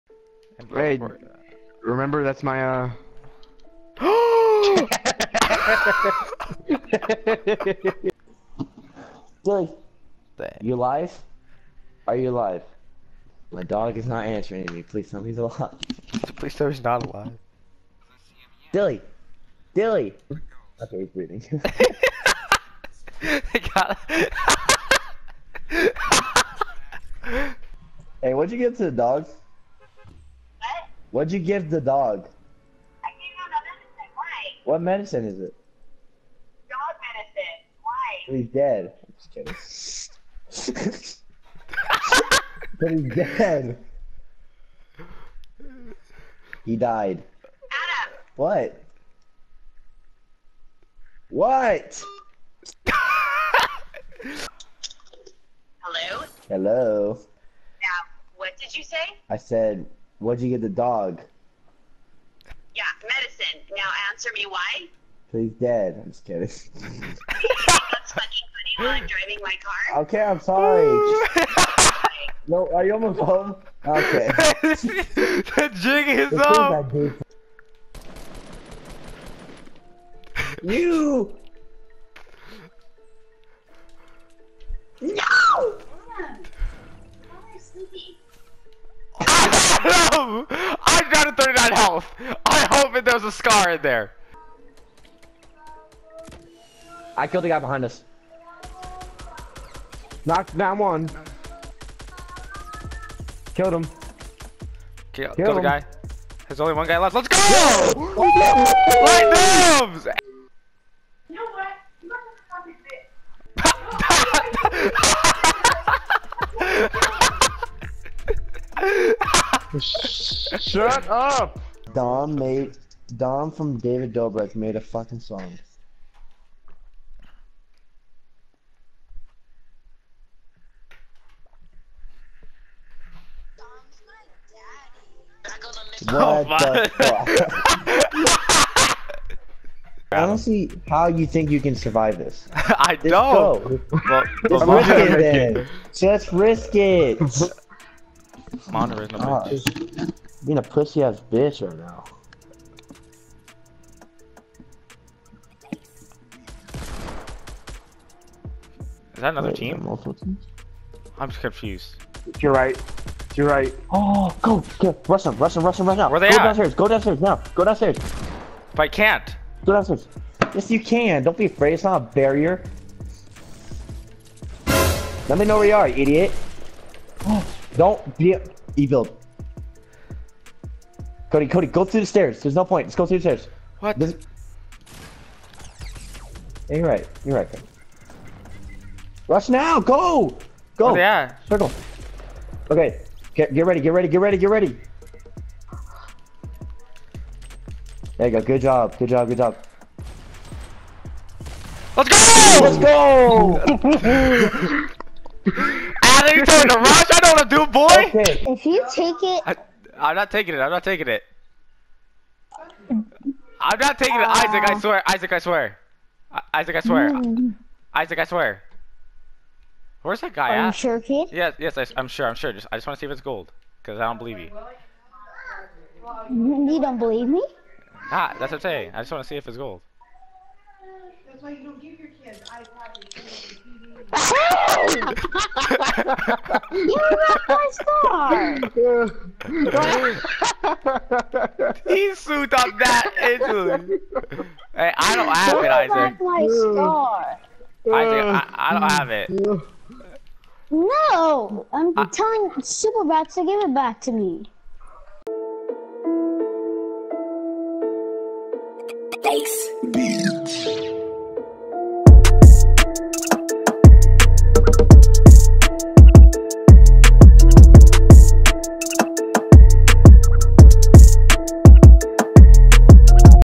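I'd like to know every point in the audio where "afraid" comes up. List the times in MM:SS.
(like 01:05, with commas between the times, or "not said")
02:51.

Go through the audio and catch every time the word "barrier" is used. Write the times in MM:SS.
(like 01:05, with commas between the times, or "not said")
02:51.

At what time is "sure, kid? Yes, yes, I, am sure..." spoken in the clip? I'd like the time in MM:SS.
03:40.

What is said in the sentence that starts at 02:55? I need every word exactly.
Let me know where you are, idiot.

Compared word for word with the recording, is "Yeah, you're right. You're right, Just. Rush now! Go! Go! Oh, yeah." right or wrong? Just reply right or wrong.
wrong.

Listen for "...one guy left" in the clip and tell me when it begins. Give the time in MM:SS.
01:46.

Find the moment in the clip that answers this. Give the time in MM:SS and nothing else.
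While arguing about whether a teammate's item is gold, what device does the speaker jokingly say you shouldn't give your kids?
03:52.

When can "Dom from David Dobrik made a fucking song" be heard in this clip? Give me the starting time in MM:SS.
02:03.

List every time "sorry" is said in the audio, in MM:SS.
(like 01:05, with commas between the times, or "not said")
01:10.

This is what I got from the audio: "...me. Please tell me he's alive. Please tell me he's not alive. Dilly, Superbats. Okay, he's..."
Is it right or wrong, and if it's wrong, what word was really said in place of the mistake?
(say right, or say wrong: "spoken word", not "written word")
wrong: "Dilly", not "Superbats".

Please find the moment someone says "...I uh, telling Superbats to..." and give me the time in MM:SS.
04:11.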